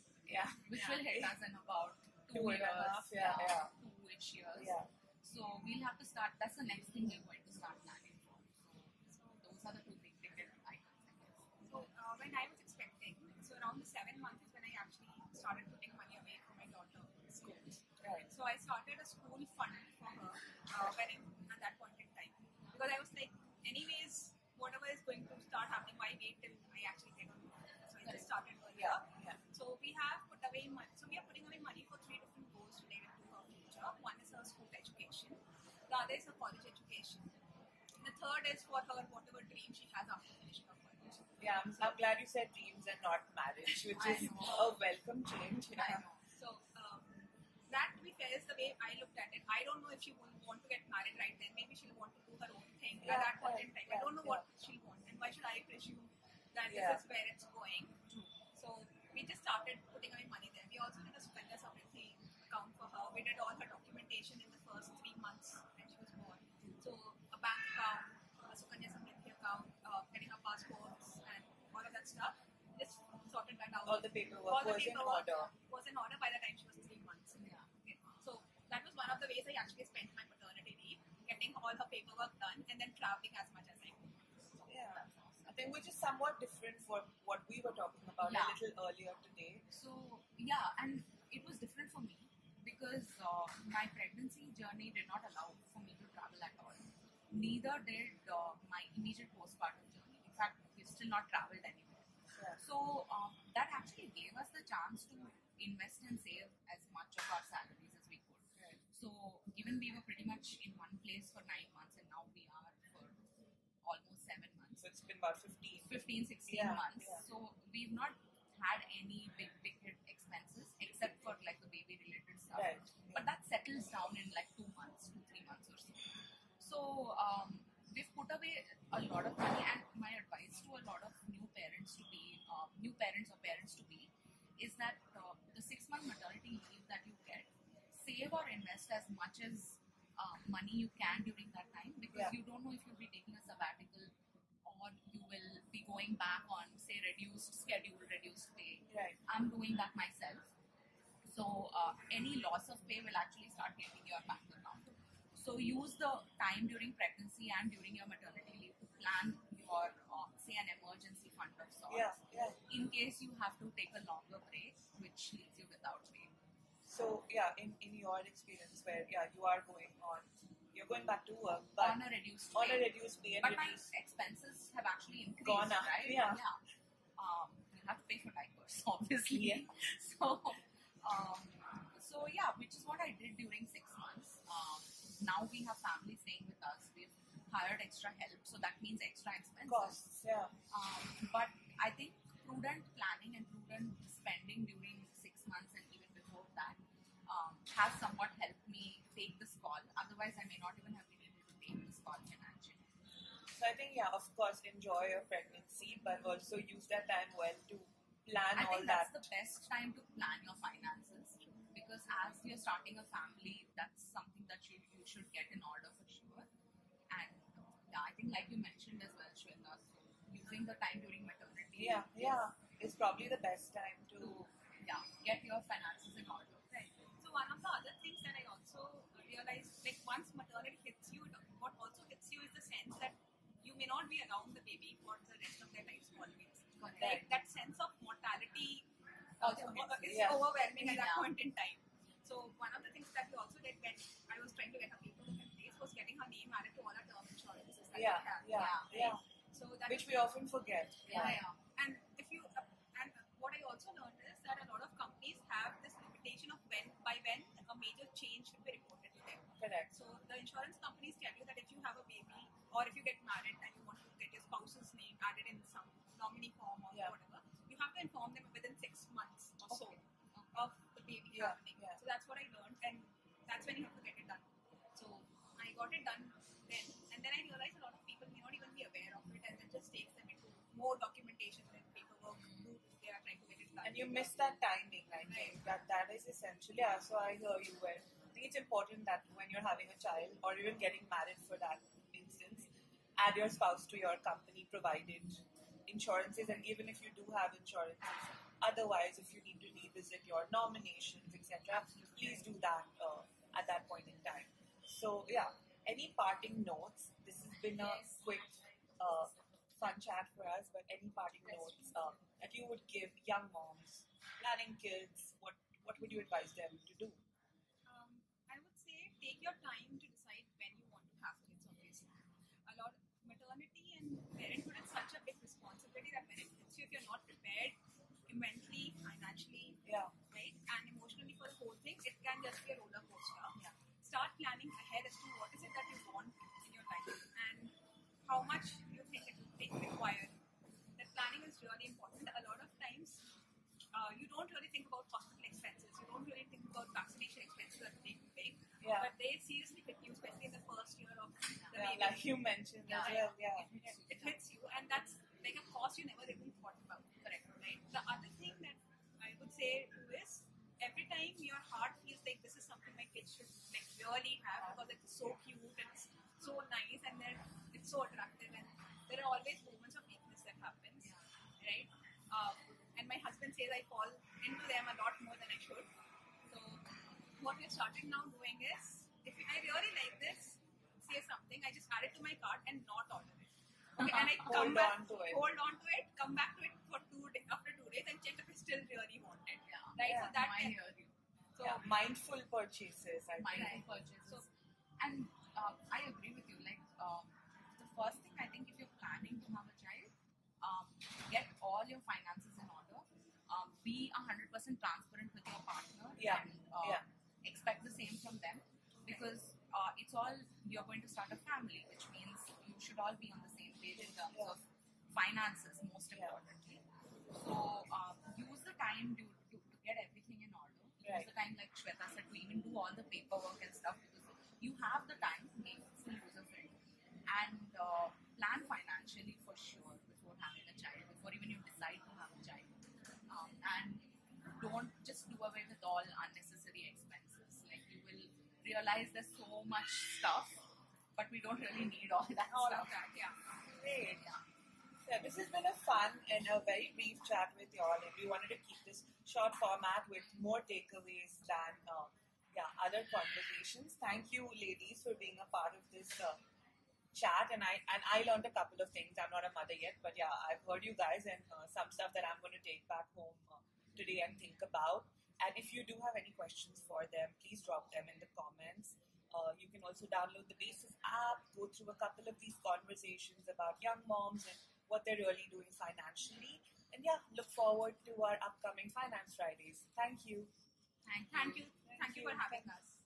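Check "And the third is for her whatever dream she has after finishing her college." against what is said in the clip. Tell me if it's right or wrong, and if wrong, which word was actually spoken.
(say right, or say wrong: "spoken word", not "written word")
right.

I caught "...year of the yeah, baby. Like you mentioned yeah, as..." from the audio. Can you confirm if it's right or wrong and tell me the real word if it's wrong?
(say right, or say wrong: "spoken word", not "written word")
right.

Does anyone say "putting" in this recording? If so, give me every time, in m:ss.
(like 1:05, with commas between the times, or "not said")
0:31, 0:59.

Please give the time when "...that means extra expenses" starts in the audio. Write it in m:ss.
3:08.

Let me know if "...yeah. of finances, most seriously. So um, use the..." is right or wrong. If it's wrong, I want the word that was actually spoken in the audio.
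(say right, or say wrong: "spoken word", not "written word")
wrong: "importantly", not "seriously".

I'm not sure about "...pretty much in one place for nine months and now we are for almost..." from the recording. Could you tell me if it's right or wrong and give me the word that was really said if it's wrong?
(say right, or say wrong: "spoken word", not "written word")
right.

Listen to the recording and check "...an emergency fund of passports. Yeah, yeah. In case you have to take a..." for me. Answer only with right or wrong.
wrong.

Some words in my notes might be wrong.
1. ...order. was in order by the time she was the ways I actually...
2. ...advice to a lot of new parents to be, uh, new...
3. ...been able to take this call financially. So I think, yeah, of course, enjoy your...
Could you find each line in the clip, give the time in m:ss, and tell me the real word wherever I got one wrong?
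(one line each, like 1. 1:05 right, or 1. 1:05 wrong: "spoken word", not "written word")
1. 1:14 right
2. 2:10 right
3. 3:21 right.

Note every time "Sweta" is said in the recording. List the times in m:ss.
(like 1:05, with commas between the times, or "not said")
3:39, 7:01.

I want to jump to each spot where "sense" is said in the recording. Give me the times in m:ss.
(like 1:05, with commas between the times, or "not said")
3:52, 3:57.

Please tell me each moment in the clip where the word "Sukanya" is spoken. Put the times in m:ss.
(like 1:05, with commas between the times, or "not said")
1:01, 1:08.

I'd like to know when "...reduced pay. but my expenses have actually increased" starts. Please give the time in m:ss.
2:52.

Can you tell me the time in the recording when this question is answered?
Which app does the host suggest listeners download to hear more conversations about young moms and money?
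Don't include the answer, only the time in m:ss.
7:50.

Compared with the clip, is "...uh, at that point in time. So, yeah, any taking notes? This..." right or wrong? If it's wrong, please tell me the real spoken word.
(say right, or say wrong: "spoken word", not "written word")
wrong: "parting", not "taking".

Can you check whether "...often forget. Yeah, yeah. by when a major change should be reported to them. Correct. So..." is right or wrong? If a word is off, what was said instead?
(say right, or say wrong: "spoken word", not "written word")
right.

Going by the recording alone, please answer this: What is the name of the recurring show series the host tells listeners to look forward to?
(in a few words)
Finance Fridays.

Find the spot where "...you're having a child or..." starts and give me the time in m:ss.
4:49.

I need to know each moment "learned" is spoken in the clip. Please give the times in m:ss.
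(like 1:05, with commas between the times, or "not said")
4:32, 7:38.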